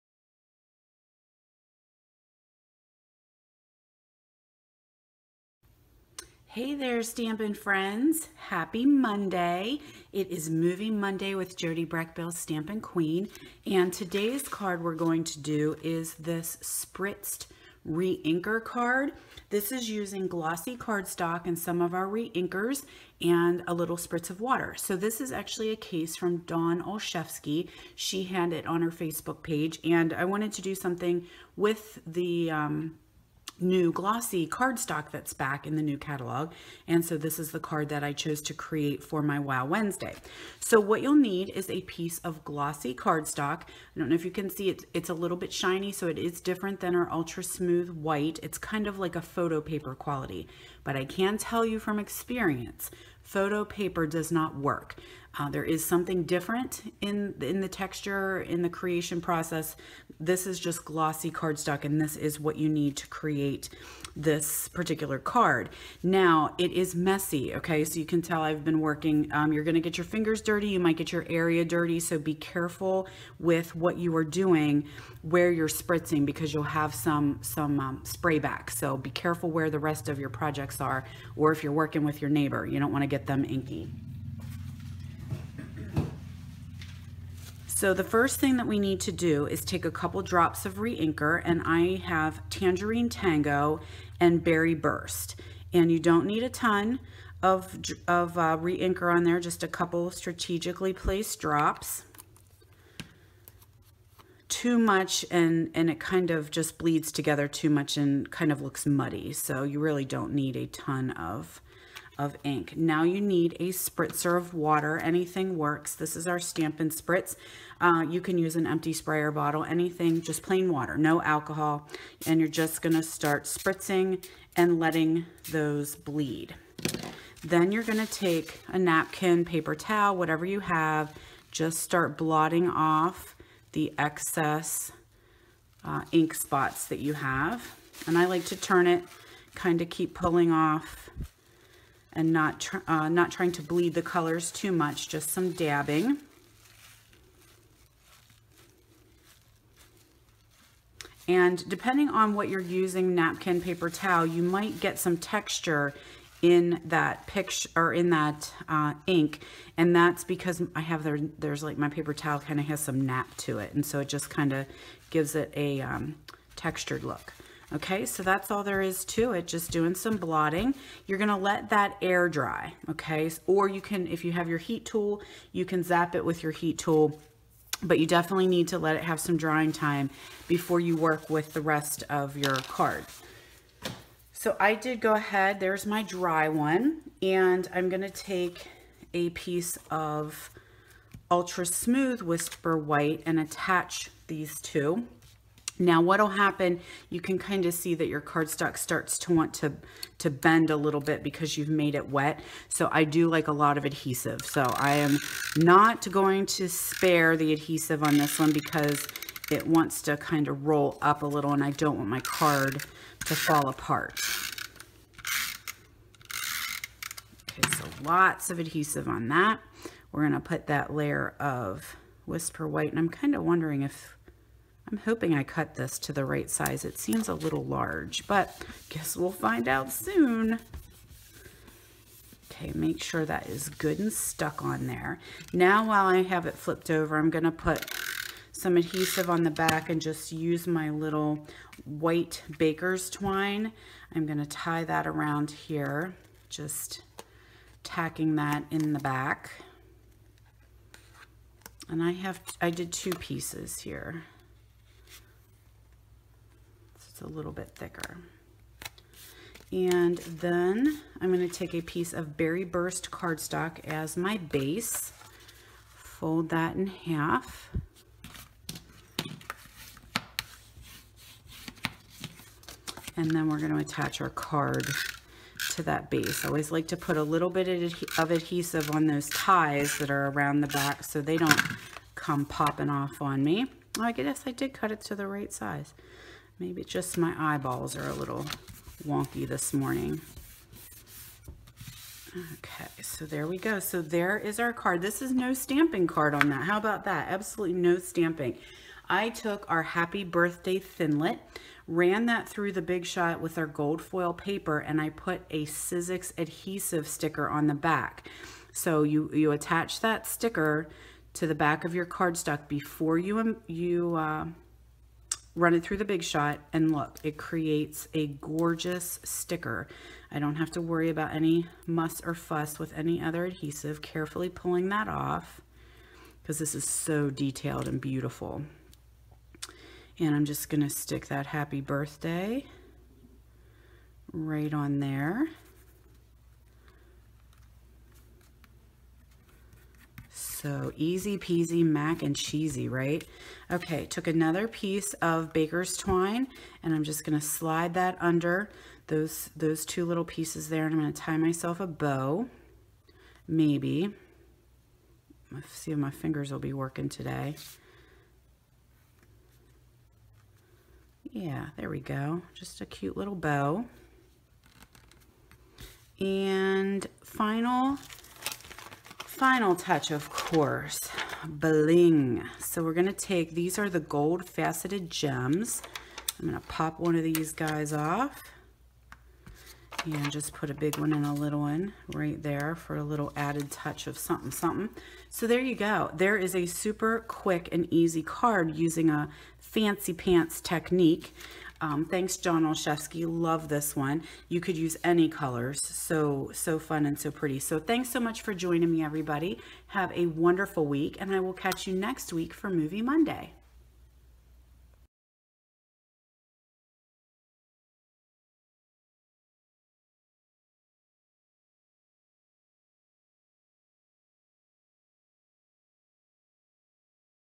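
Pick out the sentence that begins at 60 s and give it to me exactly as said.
This is just glossy cardstock, and this is what you need to create this particular card.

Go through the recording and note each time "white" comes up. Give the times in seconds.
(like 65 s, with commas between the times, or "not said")
47 s, 192 s, 222 s, 241 s.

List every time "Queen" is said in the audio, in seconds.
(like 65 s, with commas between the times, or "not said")
12 s.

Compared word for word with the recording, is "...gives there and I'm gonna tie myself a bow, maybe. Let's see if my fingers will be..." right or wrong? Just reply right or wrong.
wrong.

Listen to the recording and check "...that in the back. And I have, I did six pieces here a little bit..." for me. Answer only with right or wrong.
wrong.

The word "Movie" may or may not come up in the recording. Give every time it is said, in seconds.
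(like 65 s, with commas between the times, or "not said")
10 s, 402 s.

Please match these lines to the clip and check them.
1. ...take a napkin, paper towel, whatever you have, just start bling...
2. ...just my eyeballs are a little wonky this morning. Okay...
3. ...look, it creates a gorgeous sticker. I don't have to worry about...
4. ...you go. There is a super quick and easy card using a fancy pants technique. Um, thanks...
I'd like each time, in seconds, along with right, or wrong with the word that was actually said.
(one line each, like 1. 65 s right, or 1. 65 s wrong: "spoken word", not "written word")
1. 128 s wrong: "blotting", not "bling"
2. 286 s right
3. 316 s right
4. 385 s right.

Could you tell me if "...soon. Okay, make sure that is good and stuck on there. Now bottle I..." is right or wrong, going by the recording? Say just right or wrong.
wrong.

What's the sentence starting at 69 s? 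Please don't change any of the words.
Um, you're gonna get your fingers dirty.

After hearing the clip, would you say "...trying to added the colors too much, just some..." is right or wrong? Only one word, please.
wrong.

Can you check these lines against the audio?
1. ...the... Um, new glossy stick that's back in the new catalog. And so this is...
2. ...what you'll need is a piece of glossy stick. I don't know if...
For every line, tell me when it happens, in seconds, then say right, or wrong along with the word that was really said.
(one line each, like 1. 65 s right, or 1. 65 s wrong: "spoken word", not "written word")
1. 32 s wrong: "cardstock", not "stick"
2. 40 s wrong: "cardstock", not "stick".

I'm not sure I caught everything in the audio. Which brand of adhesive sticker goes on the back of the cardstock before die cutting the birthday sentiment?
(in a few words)
Sizzix.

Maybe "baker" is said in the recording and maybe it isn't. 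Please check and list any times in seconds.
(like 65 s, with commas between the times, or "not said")
242 s, 345 s.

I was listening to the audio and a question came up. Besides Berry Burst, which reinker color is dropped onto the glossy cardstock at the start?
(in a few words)
Tangerine Tango.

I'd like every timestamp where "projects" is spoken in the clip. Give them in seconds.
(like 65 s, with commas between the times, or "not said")
80 s.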